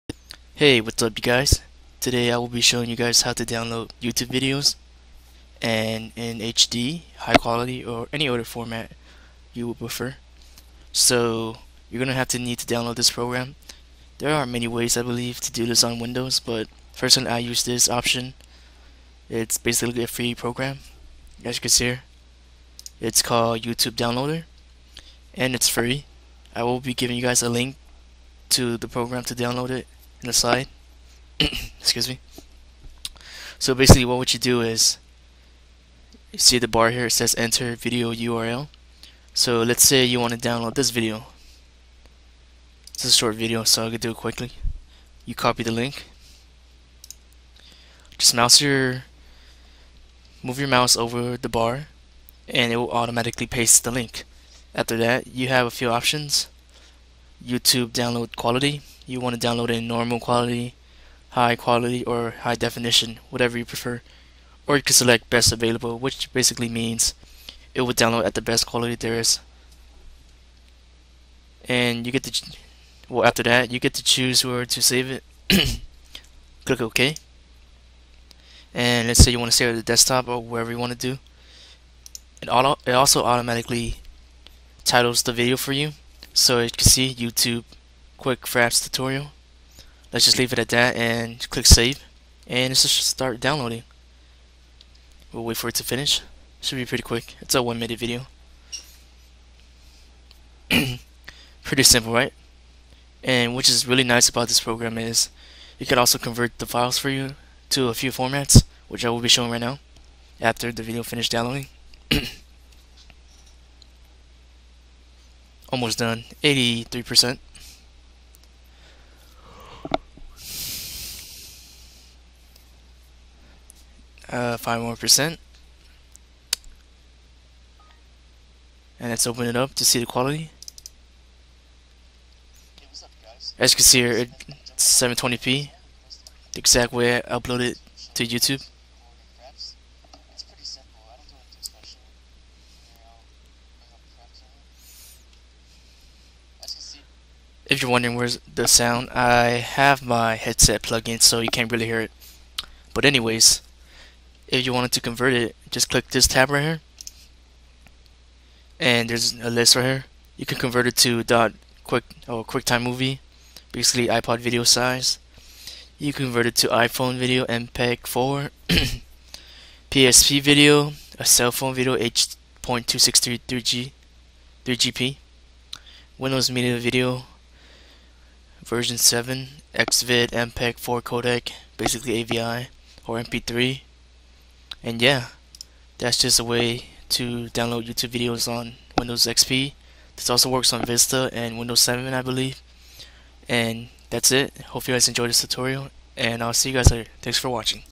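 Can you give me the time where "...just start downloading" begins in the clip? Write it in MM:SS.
01:32.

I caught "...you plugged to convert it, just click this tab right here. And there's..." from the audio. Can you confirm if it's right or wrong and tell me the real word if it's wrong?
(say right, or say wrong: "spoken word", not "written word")
wrong: "wanted", not "plugged".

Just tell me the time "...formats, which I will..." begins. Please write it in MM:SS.
01:48.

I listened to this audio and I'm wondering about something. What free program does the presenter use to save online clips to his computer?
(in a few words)
YouTube Downloader.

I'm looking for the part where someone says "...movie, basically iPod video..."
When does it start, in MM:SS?
02:42.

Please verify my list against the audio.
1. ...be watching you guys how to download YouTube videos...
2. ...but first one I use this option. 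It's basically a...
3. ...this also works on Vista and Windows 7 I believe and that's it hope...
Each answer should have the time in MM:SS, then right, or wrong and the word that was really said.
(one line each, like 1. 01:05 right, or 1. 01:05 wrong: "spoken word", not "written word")
1. 00:02 wrong: "showing", not "watching"
2. 00:16 right
3. 03:10 right.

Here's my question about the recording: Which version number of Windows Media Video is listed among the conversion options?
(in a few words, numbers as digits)
7.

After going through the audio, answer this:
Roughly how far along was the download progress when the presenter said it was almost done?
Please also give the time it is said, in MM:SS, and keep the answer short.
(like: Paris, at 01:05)
83%, at 01:56.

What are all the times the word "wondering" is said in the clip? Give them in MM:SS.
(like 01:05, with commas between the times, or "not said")
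02:27.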